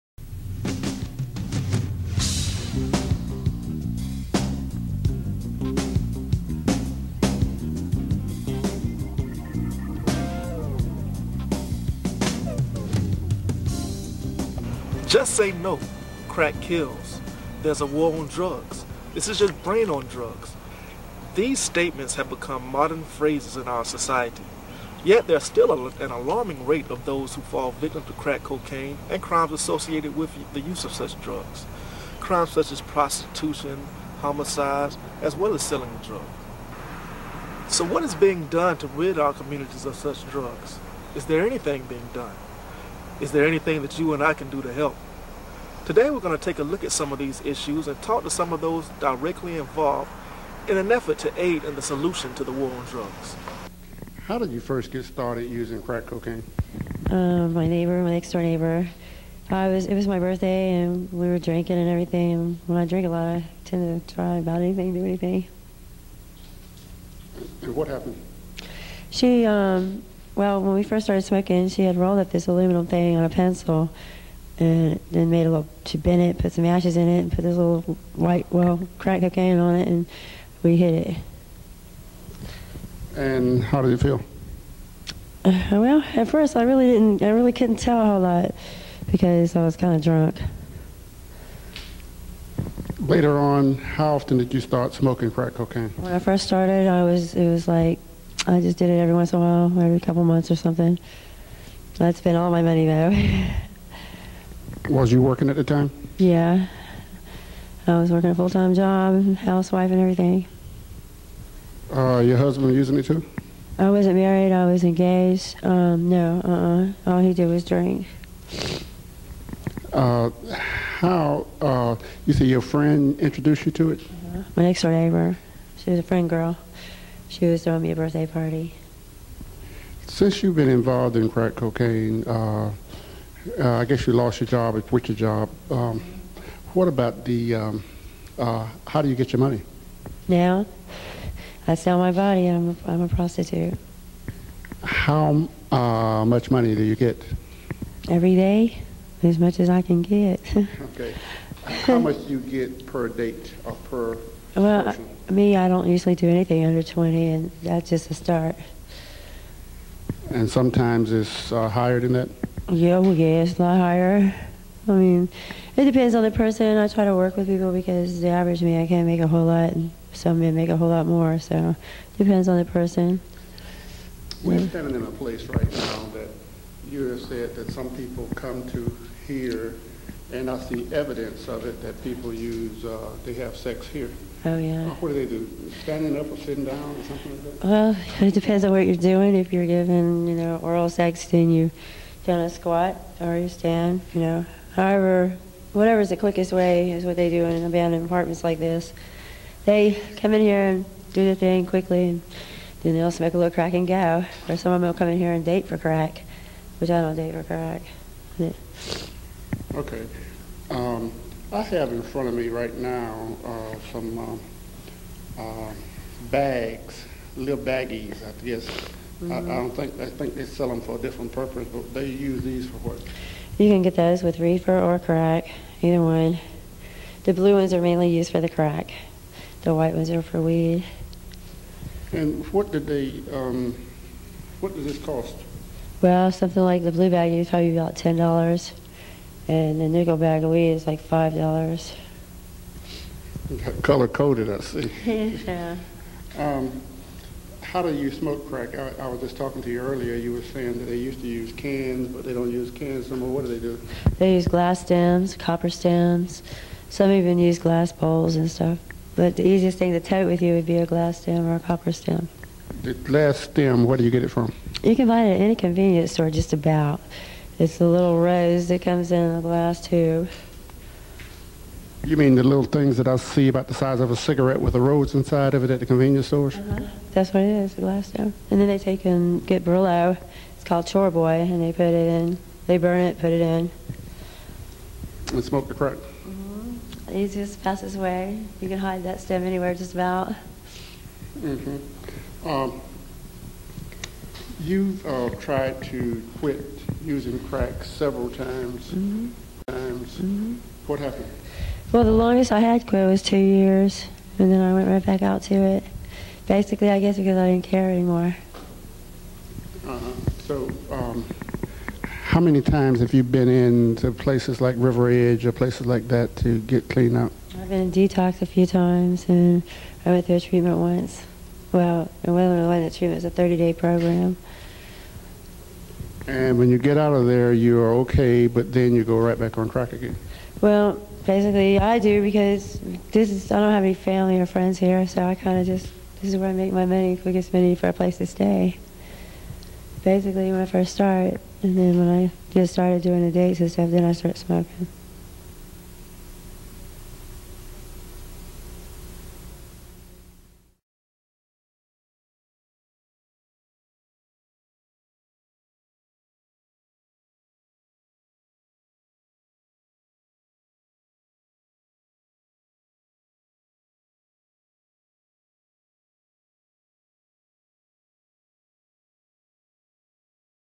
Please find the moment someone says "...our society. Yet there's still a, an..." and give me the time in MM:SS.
00:23.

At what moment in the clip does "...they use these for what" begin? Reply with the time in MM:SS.
03:41.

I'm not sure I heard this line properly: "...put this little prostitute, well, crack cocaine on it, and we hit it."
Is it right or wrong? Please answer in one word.
wrong.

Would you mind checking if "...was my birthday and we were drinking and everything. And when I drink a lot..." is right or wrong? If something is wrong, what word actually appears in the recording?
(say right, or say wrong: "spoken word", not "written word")
right.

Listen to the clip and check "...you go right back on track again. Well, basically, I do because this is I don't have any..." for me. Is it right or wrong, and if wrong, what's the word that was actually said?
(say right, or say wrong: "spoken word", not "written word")
right.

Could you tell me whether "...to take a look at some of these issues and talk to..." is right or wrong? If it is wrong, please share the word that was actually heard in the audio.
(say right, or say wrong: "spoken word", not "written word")
right.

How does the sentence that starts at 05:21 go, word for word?
Well, it wasn't really that true.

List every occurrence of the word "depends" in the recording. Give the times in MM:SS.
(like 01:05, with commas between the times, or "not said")
02:45, 02:52, 03:08.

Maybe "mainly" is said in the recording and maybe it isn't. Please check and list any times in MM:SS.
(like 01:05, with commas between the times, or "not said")
03:47.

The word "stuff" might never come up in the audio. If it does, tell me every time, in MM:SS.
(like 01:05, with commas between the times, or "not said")
04:18, 05:43.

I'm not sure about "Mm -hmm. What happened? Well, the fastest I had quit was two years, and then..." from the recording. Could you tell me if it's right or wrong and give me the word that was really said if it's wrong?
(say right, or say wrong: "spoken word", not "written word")
wrong: "longest", not "fastest".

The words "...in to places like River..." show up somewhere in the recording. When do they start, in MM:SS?
05:13.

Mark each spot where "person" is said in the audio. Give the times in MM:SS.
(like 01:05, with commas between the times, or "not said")
02:46, 02:52.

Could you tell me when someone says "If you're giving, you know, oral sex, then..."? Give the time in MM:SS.
03:09.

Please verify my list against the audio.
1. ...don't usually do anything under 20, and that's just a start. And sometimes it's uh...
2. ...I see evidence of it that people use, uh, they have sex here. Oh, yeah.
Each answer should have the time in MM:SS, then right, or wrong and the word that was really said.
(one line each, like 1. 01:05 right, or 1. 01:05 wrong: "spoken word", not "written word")
1. 02:35 right
2. 03:00 right.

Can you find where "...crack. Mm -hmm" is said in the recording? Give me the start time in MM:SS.
04:45.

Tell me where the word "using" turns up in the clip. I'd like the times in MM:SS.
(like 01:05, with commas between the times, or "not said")
00:55, 01:52, 04:57.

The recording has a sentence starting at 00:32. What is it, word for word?
Crimes such as prostitution, homicides, as well as selling drugs.